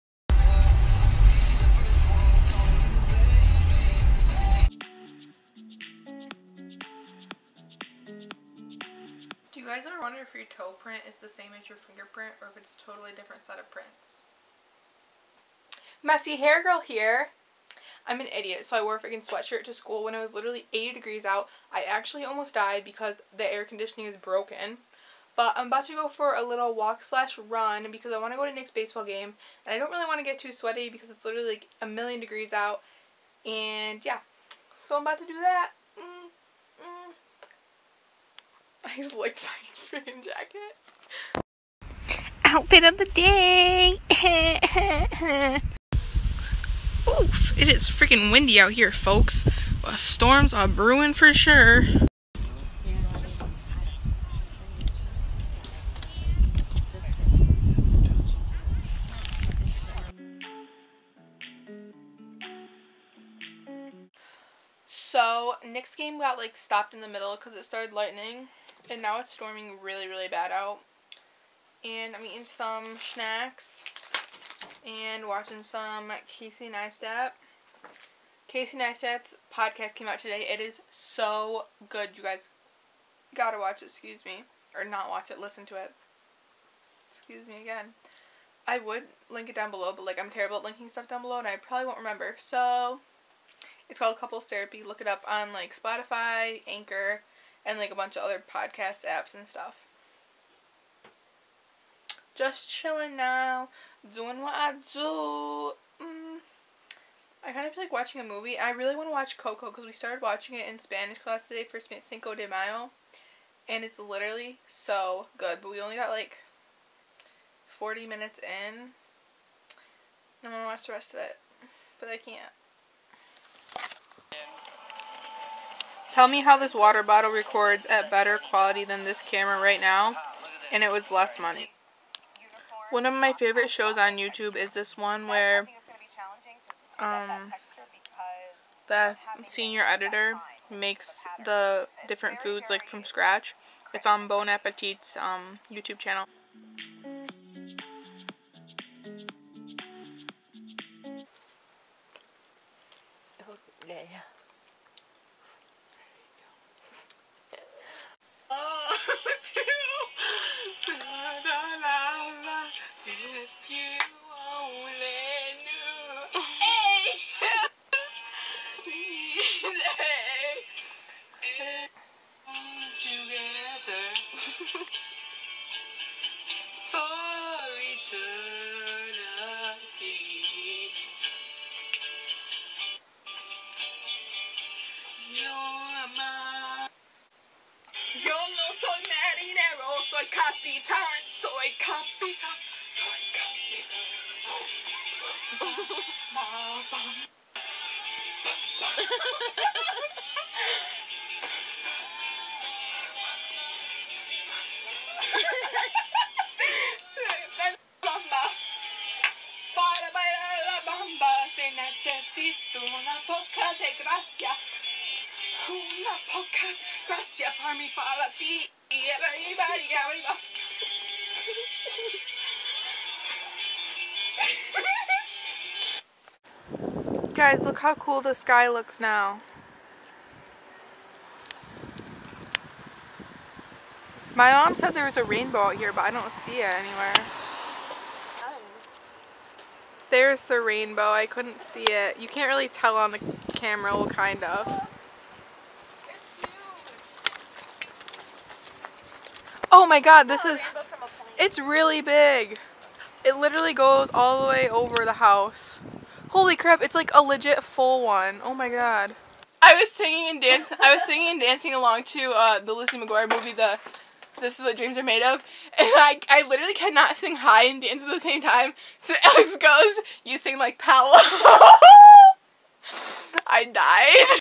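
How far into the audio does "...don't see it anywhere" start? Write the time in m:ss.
3:56.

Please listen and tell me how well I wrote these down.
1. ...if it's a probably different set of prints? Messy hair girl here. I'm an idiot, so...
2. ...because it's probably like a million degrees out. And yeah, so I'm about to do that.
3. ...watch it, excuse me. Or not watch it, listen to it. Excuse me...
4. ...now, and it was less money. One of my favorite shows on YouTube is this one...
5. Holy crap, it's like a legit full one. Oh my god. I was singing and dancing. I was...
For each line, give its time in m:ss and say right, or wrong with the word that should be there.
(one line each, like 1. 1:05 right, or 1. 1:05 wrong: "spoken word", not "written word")
1. 0:12 wrong: "totally", not "probably"
2. 0:30 wrong: "literally", not "probably"
3. 1:23 right
4. 2:09 right
5. 4:16 right.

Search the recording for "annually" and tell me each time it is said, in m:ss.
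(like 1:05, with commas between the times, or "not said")
not said.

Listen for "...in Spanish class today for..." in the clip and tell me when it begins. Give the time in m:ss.
1:50.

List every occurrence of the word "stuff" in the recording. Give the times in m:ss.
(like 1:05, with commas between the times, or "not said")
1:30, 1:39.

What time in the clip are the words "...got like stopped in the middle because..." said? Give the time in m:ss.
1:06.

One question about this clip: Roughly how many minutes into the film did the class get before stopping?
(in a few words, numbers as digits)
40.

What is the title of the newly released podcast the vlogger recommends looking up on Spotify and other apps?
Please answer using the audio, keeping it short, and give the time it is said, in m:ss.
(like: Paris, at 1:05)
Couples Therapy, at 1:34.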